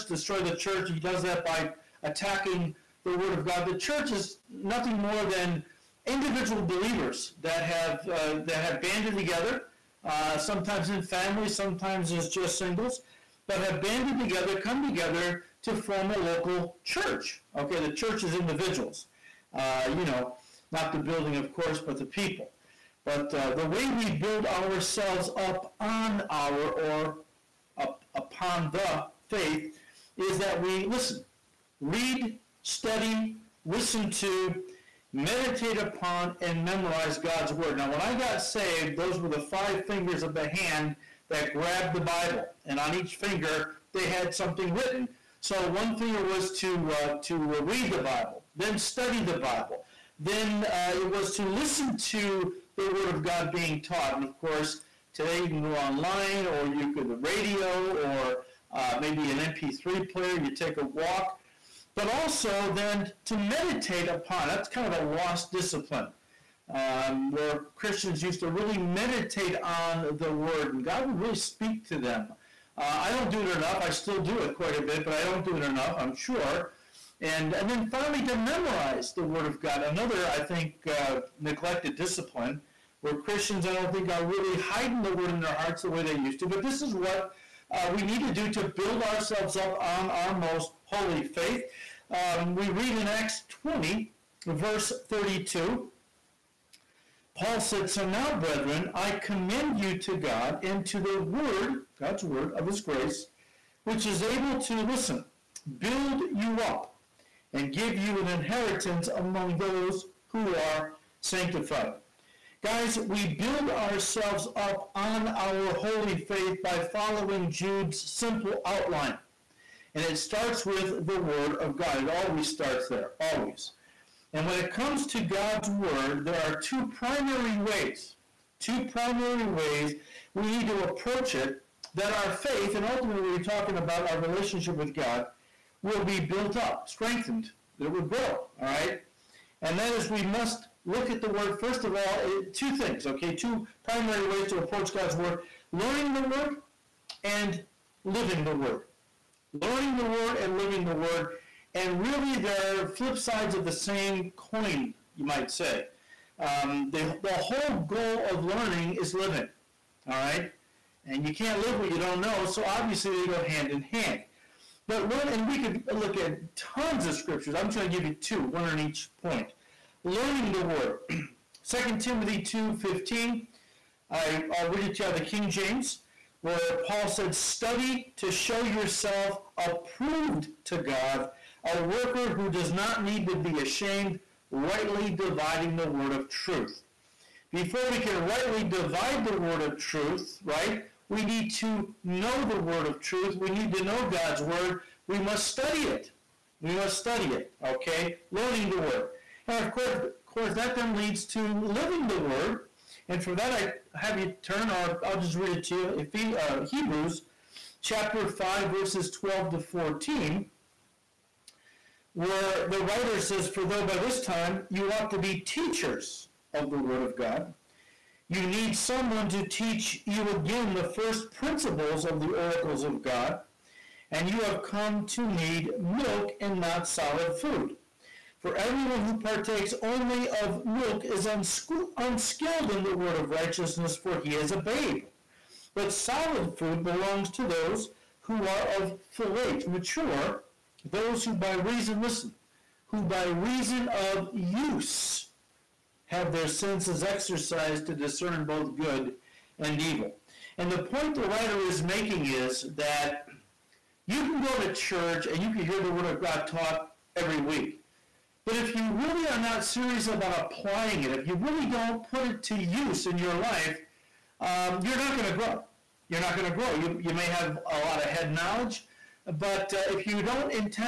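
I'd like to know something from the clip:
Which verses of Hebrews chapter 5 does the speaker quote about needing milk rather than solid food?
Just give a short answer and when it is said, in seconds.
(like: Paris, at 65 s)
12 to 14, at 208 s.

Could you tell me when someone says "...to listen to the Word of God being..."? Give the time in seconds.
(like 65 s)
51 s.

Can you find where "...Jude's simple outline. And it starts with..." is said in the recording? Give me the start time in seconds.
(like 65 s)
117 s.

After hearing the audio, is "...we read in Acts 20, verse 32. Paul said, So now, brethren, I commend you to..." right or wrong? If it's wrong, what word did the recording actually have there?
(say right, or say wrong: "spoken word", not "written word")
right.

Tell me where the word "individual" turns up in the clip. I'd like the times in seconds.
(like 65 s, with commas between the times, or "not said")
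6 s, 18 s.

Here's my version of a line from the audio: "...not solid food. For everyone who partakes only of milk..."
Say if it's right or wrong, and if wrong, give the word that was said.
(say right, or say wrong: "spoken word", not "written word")
right.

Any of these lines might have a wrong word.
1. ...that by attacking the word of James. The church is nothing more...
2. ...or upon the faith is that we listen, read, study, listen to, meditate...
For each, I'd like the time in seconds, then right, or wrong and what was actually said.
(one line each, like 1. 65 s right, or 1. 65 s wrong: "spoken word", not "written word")
1. 1 s wrong: "God", not "James"
2. 26 s right.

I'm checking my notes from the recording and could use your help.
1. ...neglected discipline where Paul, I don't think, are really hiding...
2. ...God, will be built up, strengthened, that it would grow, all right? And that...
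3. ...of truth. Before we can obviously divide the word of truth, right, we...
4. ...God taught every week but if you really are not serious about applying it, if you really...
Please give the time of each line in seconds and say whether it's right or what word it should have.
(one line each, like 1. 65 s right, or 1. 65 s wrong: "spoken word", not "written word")
1. 81 s wrong: "Christians", not "Paul"
2. 134 s right
3. 186 s wrong: "rightly", not "obviously"
4. 256 s right.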